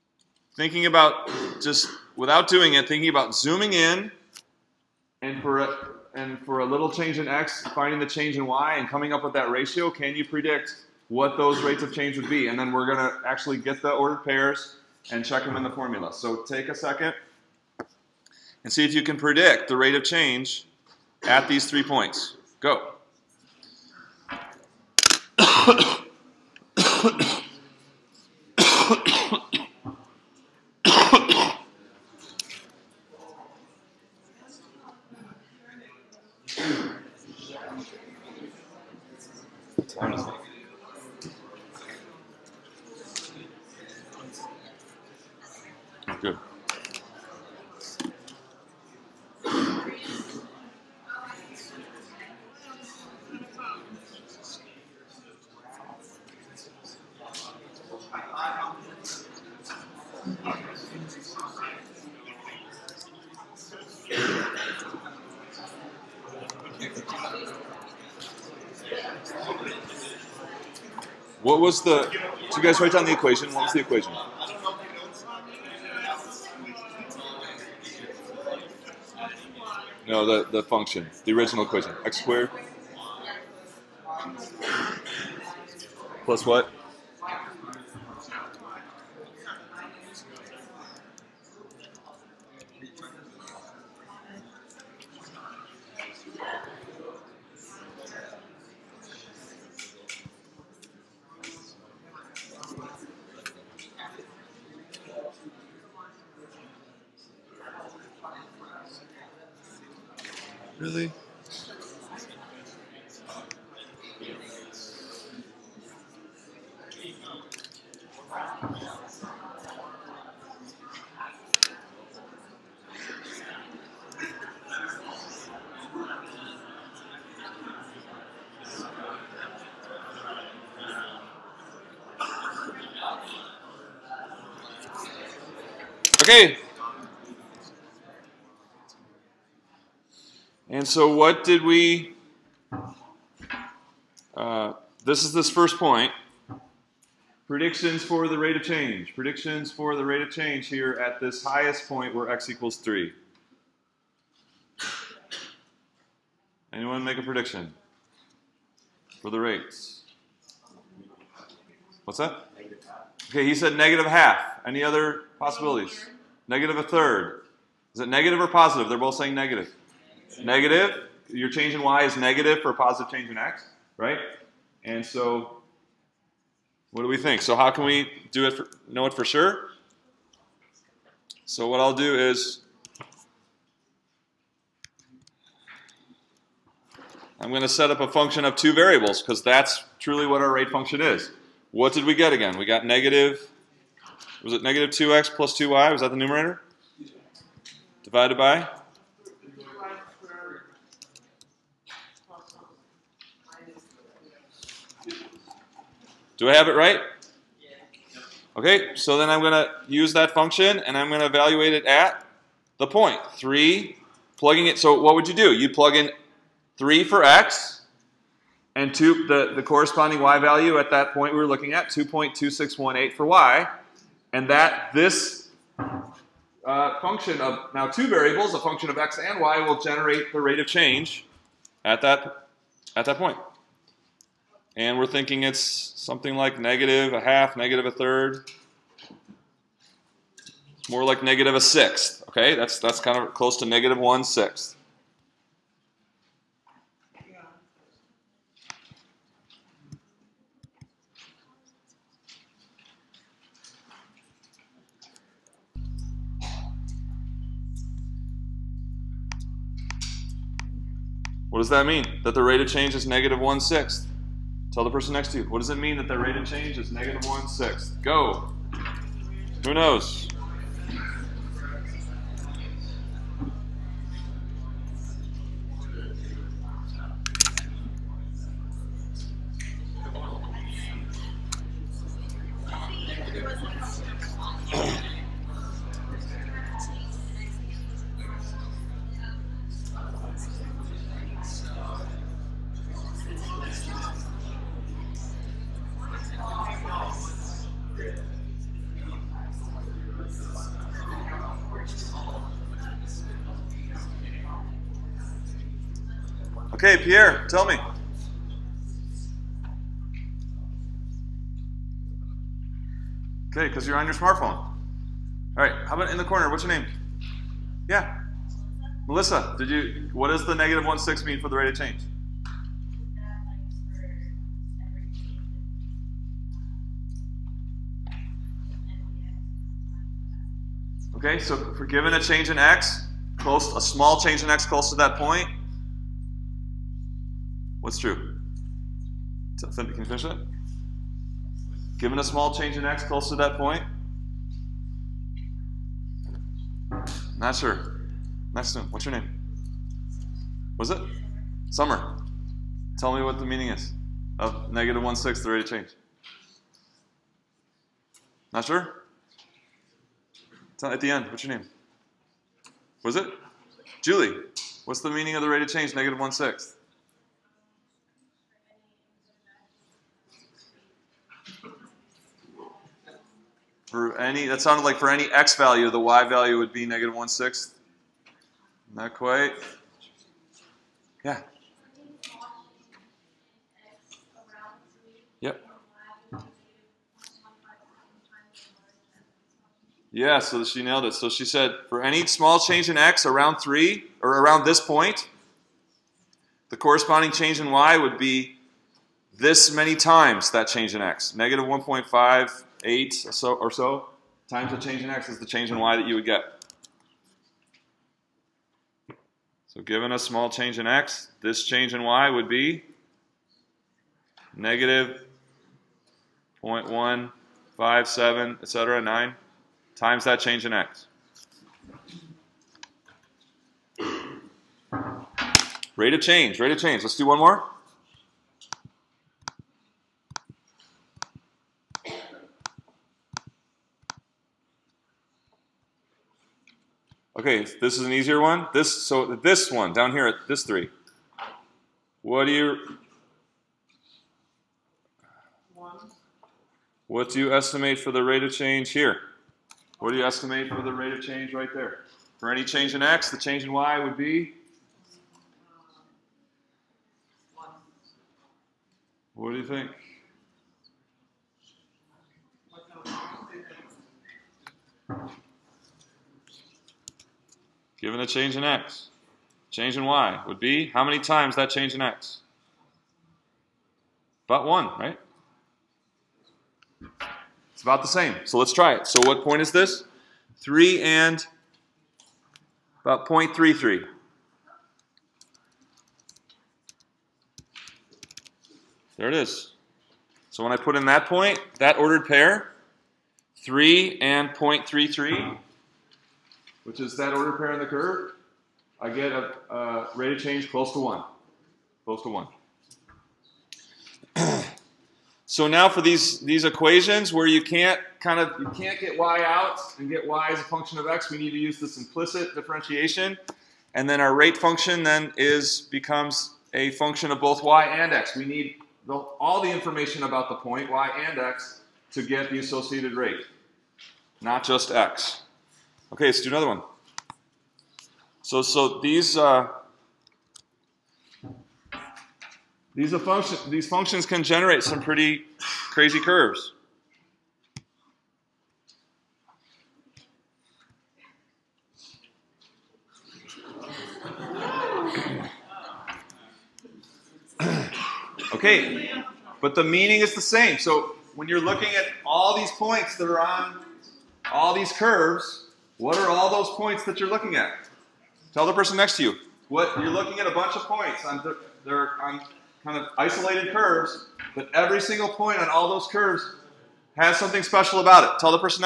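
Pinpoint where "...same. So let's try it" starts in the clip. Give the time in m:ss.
7:58.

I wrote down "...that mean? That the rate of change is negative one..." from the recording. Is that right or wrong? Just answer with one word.
right.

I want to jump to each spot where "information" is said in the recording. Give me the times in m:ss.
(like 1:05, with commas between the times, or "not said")
8:39.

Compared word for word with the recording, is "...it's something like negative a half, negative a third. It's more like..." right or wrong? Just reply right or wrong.
right.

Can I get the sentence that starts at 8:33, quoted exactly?
And then our rate function then is, becomes a function of both y and x.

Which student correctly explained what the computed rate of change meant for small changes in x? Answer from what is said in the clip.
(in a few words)
Julie.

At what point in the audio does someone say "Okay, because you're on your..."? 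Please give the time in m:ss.
5:13.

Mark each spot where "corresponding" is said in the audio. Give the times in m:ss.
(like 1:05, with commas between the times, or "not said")
3:39, 6:36.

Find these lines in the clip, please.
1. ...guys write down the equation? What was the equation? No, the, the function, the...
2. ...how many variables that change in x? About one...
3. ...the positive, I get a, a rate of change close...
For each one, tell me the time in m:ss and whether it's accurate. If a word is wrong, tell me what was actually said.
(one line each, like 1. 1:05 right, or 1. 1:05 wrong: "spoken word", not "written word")
1. 1:12 right
2. 7:50 wrong: "times", not "variables"
3. 8:17 wrong: "curve", not "positive".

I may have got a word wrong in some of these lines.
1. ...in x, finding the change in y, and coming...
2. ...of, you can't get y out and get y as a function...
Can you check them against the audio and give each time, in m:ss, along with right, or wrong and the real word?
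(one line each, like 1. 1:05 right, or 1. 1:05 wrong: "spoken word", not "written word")
1. 0:07 right
2. 8:28 right.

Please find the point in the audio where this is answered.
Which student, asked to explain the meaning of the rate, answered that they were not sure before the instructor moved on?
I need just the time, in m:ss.
5:51.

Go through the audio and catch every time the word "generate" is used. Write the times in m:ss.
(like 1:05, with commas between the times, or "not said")
3:49, 8:54.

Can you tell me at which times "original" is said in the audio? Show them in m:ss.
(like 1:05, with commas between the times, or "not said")
1:21.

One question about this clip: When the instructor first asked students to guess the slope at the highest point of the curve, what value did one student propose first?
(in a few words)
negative half.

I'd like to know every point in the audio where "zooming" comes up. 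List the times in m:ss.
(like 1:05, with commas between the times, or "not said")
0:03.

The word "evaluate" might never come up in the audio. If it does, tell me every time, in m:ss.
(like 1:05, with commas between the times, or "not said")
3:31.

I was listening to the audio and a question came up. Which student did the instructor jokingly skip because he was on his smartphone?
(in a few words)
Pierre.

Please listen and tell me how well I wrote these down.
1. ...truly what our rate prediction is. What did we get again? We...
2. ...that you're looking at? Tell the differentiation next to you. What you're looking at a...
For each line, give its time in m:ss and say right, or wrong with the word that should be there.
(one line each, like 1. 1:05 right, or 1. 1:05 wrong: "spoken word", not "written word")
1. 3:09 wrong: "function", not "prediction"
2. 9:17 wrong: "person", not "differentiation".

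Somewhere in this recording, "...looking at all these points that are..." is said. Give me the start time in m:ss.
9:11.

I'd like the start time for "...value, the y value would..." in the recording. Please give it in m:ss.
6:15.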